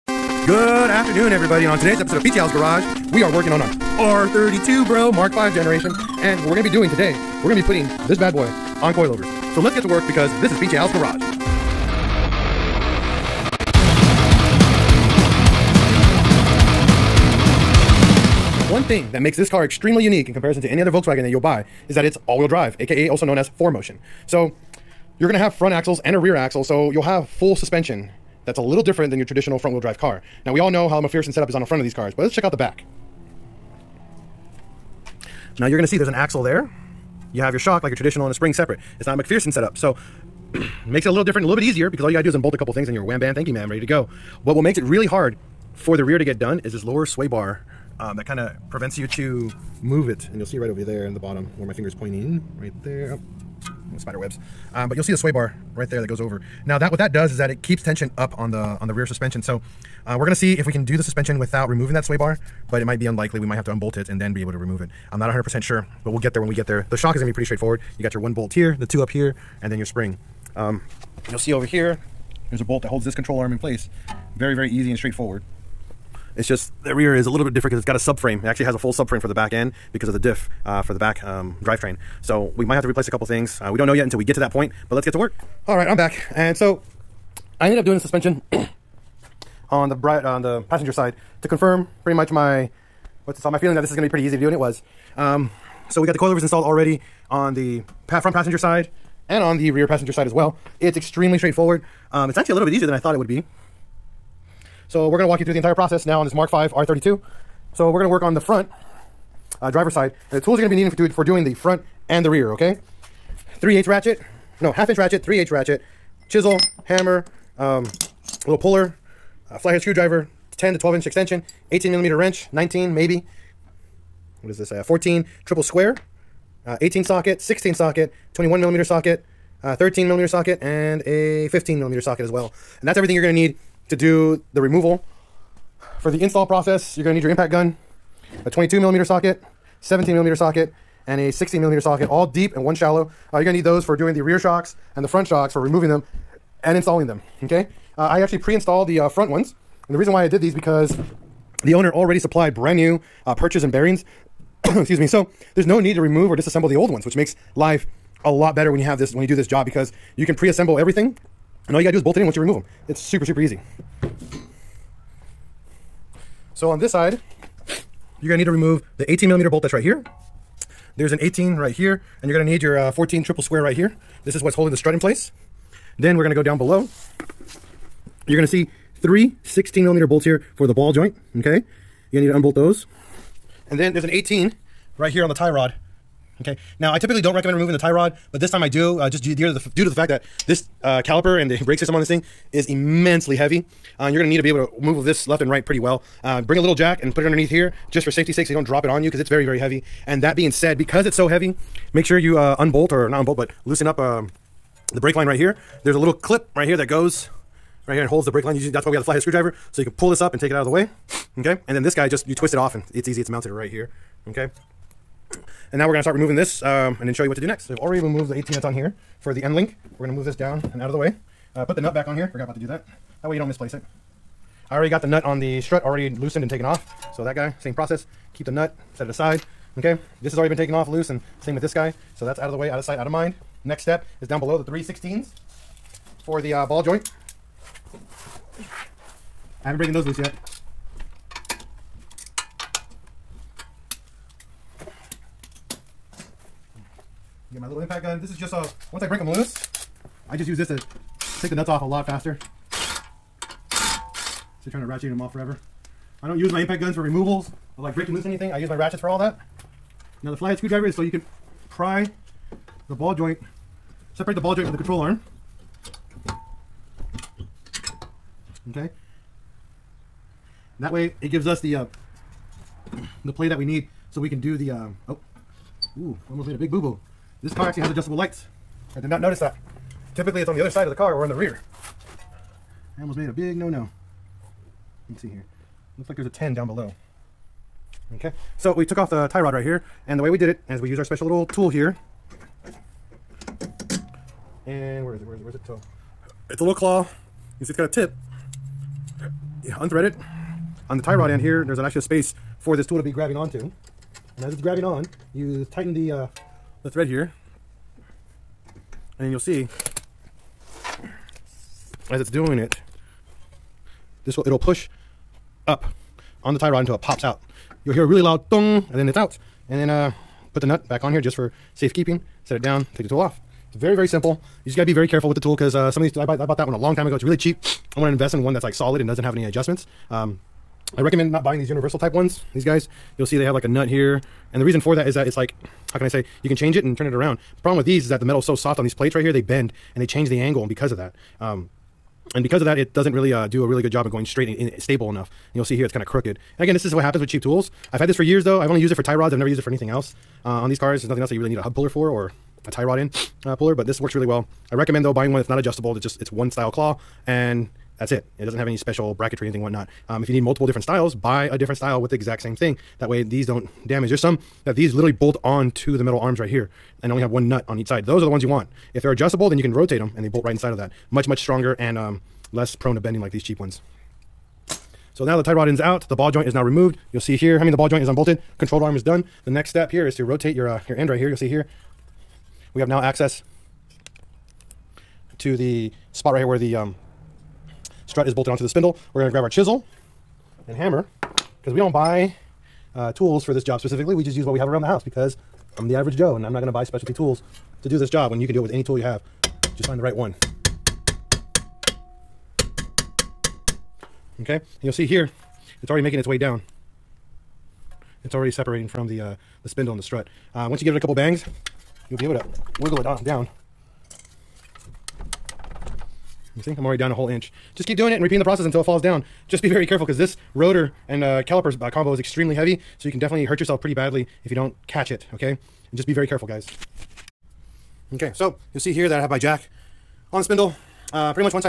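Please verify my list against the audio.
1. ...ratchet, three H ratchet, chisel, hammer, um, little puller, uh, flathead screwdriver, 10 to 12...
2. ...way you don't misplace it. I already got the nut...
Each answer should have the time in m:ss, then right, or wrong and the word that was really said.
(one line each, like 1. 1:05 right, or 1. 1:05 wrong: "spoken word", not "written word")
1. 1:54 right
2. 3:43 right.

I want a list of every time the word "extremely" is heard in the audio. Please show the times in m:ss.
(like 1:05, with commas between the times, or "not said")
0:19, 1:40, 7:02.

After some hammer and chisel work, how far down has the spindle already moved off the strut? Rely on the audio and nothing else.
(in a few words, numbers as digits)
1 inch.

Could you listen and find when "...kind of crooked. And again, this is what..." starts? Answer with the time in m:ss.
5:45.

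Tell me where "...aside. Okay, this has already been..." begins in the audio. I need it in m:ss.
3:49.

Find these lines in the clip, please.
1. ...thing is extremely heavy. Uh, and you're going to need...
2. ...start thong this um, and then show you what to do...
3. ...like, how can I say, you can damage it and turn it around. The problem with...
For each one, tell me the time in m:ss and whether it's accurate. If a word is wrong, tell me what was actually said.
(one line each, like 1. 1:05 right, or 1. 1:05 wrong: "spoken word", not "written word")
1. 3:12 wrong: "immensely", not "extremely"
2. 3:36 wrong: "removing", not "thong"
3. 5:35 wrong: "change", not "damage".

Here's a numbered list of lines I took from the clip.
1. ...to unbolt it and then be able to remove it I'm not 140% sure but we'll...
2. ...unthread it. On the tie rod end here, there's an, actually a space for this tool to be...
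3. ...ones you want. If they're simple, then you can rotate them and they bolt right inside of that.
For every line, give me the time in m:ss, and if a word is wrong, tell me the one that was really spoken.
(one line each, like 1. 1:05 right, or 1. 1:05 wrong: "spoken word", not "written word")
1. 1:03 wrong: "100", not "140"
2. 4:59 right
3. 6:08 wrong: "adjustable", not "simple".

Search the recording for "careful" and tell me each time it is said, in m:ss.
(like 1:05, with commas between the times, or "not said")
5:25, 6:59, 7:06.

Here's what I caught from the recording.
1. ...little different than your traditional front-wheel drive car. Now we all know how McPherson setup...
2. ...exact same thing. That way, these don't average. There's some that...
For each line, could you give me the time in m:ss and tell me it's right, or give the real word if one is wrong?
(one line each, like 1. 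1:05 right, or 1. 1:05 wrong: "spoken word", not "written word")
1. 0:28 right
2. 6:02 wrong: "damage", not "average".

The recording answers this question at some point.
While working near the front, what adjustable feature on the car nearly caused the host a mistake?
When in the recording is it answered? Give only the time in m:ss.
4:37.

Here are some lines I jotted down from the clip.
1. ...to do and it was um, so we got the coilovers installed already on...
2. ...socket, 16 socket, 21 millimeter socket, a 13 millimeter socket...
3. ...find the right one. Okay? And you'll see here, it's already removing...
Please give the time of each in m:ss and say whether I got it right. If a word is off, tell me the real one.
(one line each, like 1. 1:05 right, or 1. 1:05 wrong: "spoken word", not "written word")
1. 1:34 right
2. 2:07 right
3. 6:39 wrong: "making", not "removing".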